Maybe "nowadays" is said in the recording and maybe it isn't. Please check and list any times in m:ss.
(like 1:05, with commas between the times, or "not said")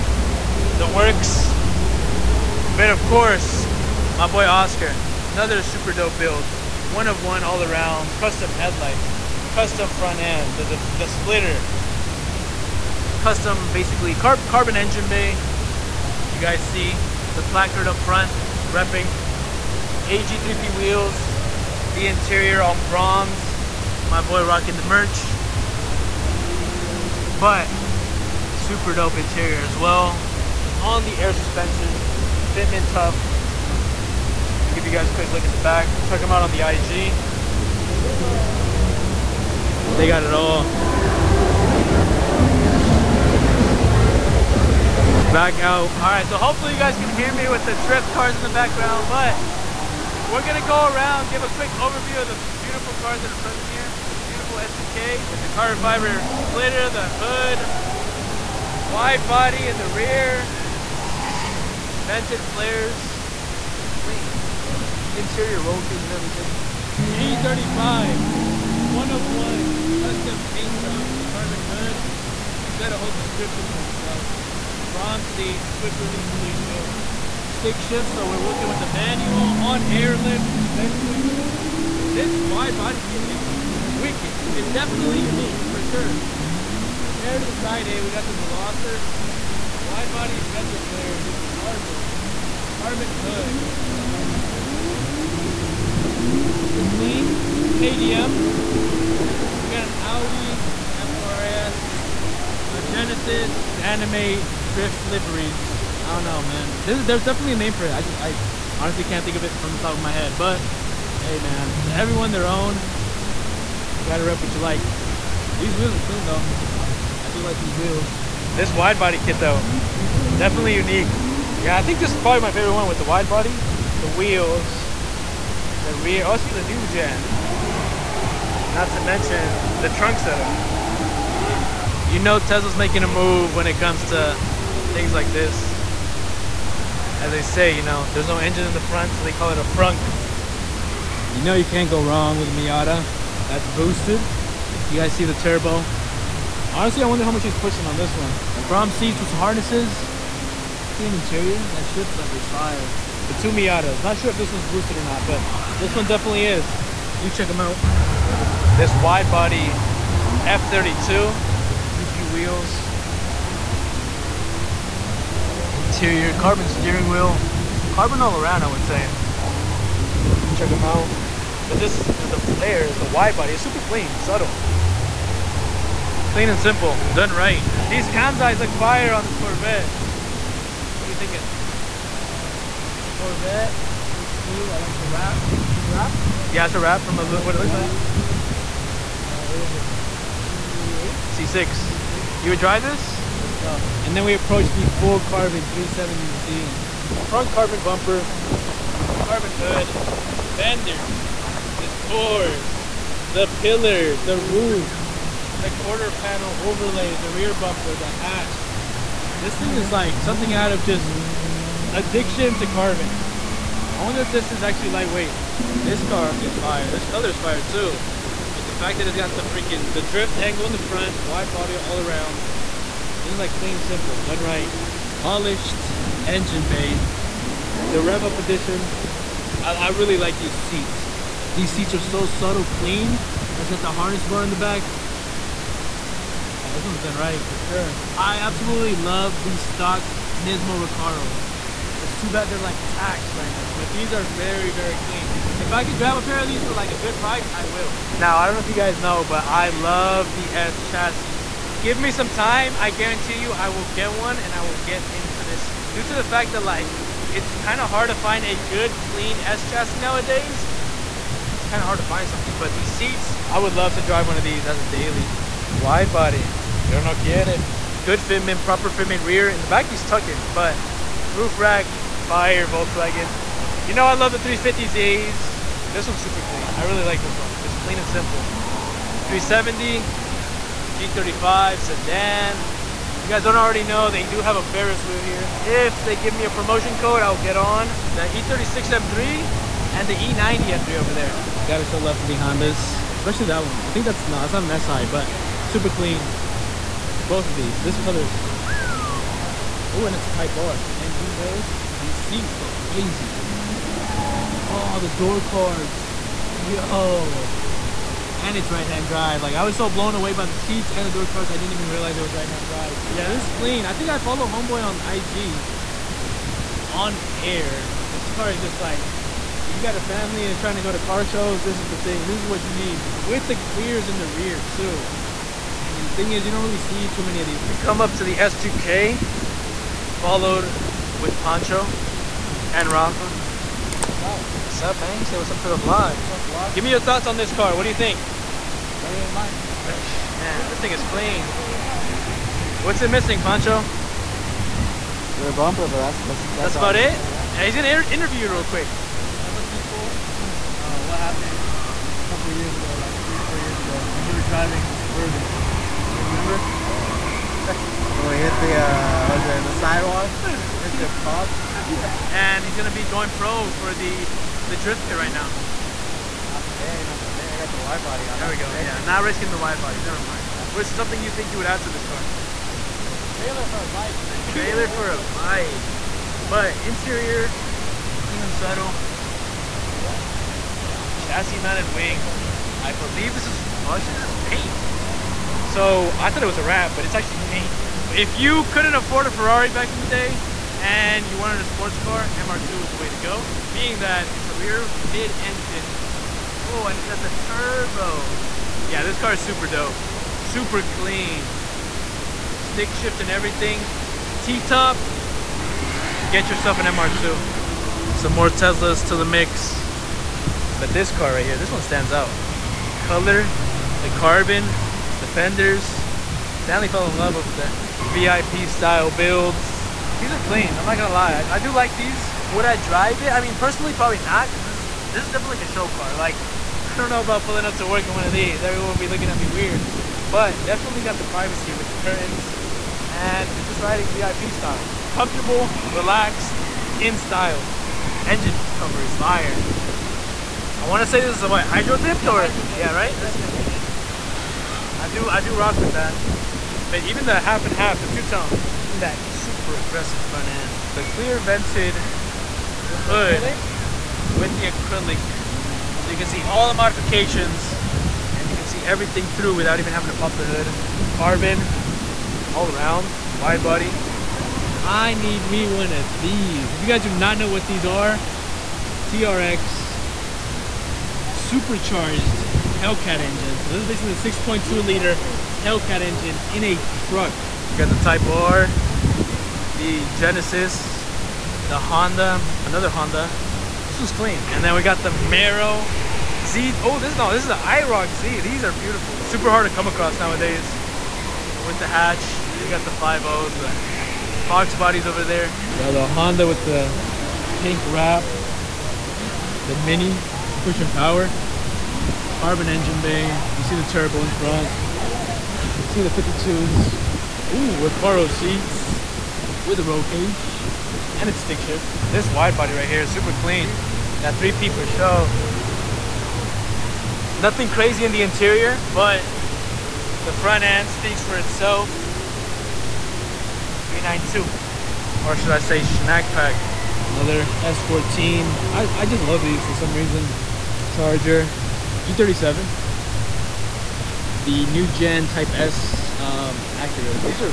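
4:19, 8:10.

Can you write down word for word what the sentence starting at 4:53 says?
I think that's not, it's not an SI, but super clean.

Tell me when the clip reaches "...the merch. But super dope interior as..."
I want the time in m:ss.
0:24.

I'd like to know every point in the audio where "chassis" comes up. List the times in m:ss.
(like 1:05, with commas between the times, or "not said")
4:10, 4:19, 6:21.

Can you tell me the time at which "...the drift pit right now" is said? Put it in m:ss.
6:04.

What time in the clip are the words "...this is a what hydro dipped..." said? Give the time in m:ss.
7:21.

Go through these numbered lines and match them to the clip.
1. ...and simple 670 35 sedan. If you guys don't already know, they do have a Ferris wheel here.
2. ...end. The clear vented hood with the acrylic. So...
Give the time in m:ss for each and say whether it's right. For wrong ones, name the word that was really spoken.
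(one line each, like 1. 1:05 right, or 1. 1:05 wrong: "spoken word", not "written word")
1. 4:37 wrong: "370", not "670"
2. 7:30 right.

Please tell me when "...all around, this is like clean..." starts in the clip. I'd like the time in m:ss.
3:41.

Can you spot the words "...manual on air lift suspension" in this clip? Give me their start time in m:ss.
1:18.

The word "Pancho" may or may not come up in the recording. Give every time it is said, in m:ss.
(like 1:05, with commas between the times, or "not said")
5:31, 5:43.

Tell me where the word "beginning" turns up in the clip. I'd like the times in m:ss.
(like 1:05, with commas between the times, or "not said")
not said.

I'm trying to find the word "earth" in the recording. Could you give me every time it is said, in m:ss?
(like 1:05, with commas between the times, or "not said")
not said.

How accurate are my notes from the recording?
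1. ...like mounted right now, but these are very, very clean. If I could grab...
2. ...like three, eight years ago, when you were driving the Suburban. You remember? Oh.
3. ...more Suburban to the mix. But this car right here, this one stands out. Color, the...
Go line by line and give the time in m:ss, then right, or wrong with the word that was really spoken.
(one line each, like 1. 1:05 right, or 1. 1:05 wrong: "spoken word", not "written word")
1. 4:02 wrong: "taxed", not "mounted"
2. 5:53 wrong: "four", not "eight"
3. 6:48 wrong: "Teslas", not "Suburban".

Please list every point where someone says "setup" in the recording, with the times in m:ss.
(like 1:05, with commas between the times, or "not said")
2:10.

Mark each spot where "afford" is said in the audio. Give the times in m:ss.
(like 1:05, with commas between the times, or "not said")
6:28.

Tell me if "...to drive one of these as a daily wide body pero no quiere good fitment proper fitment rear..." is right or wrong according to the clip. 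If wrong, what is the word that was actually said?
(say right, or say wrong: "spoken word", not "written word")
right.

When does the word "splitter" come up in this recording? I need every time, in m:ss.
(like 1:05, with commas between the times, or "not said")
0:11, 0:56.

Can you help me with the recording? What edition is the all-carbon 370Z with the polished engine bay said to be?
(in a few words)
Rev up edition.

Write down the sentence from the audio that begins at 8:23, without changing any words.
You see the turbo in front.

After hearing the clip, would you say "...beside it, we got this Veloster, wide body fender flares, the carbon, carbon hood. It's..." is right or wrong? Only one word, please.
right.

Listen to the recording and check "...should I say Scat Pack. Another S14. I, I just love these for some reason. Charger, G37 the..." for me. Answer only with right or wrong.
right.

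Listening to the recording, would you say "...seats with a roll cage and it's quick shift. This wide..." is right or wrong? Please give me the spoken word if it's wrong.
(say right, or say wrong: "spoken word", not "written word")
wrong: "stick", not "quick".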